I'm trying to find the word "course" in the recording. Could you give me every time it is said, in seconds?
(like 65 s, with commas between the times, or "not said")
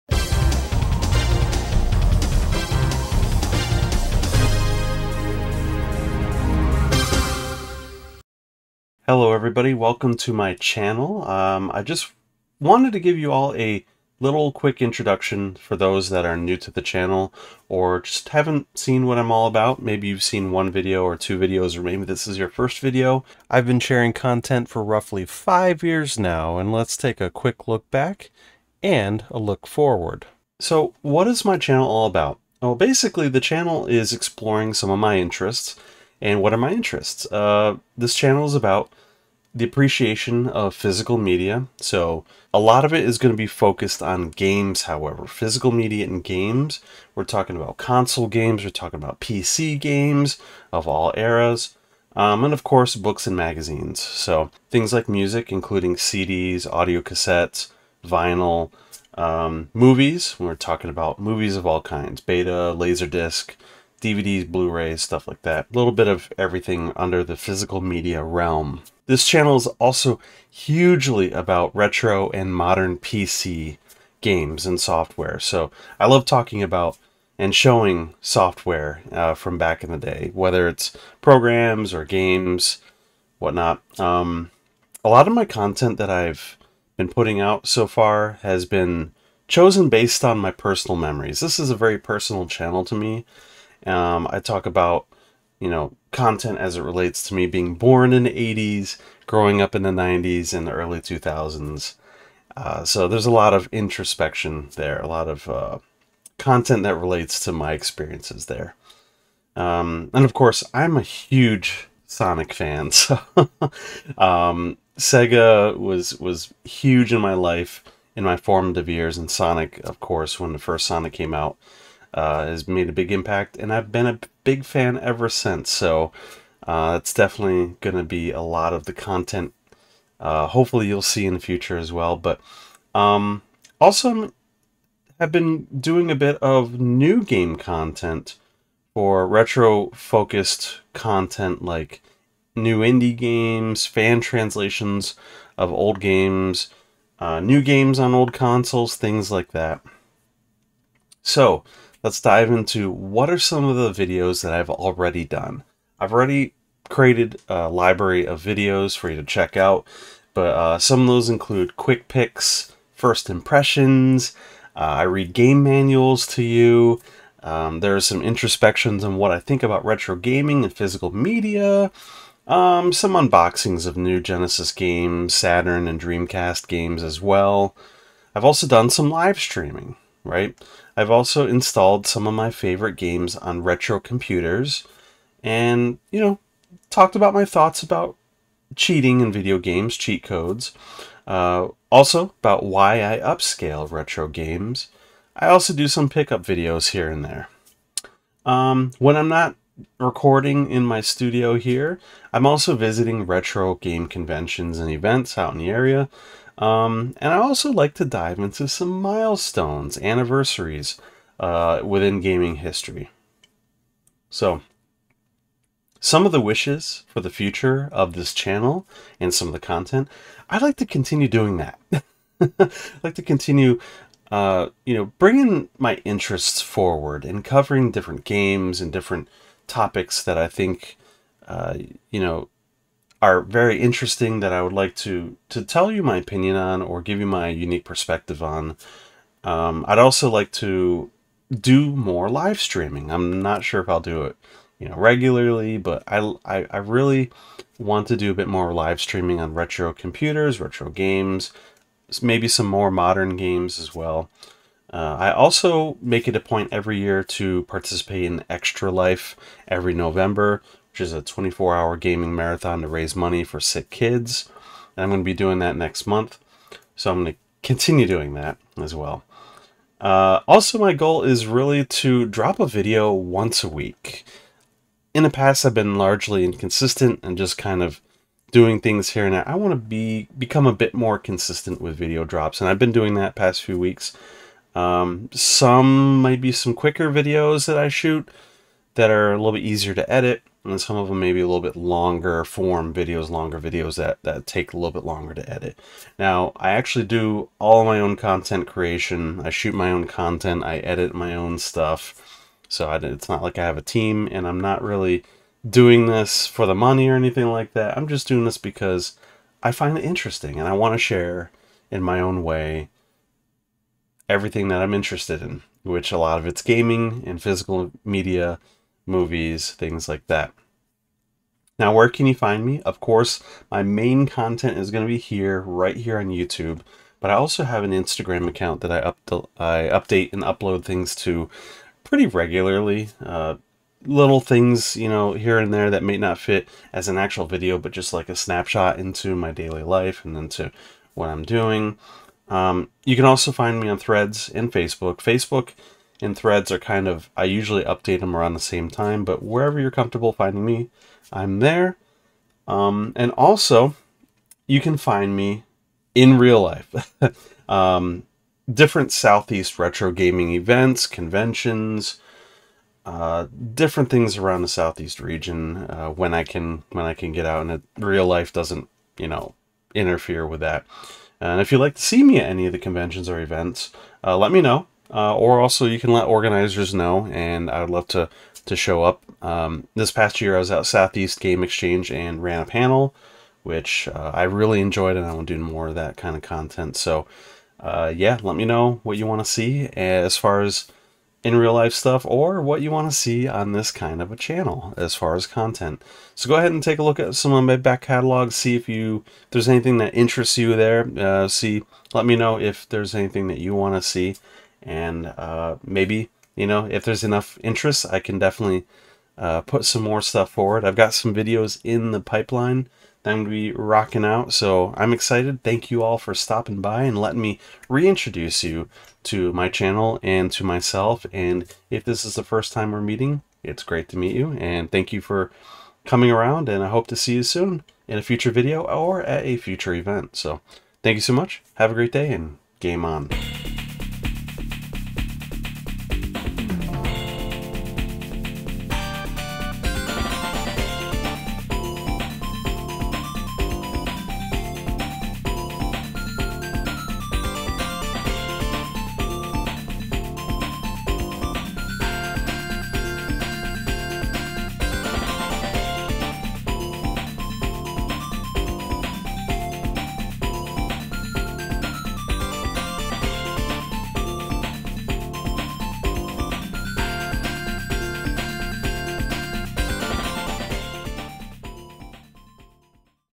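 52 s, 110 s, 120 s, 322 s.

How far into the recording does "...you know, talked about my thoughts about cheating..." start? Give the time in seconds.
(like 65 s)
186 s.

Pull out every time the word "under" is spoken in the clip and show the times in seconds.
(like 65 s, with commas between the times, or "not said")
66 s.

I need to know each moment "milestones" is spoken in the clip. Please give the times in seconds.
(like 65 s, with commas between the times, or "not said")
209 s.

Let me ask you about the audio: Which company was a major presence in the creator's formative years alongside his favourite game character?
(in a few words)
Sega.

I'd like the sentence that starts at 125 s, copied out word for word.
So uh, it's definitely going to be a lot of the content.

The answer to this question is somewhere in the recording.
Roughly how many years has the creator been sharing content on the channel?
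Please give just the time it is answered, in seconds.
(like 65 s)
25 s.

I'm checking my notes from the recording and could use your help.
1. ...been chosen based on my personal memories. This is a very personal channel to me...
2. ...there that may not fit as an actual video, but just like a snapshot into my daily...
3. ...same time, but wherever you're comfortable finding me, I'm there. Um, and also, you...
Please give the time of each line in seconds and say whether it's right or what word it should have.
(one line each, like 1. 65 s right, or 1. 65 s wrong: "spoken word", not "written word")
1. 88 s right
2. 335 s right
3. 348 s right.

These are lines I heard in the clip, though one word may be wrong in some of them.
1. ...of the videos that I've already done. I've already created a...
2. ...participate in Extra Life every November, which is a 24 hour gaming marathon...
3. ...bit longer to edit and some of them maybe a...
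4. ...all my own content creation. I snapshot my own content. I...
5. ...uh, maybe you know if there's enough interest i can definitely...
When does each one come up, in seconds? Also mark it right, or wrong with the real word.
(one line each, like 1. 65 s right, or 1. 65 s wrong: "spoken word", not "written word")
1. 153 s right
2. 257 s right
3. 289 s wrong: "easier", not "longer"
4. 297 s wrong: "shoot", not "snapshot"
5. 405 s right.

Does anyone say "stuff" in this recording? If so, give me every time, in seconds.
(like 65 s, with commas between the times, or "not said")
65 s, 301 s, 391 s, 410 s.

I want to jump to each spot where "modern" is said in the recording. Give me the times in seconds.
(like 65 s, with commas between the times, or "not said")
72 s, 252 s.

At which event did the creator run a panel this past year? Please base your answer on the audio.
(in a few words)
Southeast Game Exchange.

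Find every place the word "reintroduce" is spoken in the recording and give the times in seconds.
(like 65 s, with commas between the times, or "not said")
417 s.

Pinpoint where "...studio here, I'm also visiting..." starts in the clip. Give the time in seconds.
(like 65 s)
201 s.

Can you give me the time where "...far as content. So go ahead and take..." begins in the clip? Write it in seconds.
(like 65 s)
395 s.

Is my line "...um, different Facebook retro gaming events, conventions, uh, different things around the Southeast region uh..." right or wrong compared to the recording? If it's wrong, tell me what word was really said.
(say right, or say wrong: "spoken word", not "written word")
wrong: "Southeast", not "Facebook".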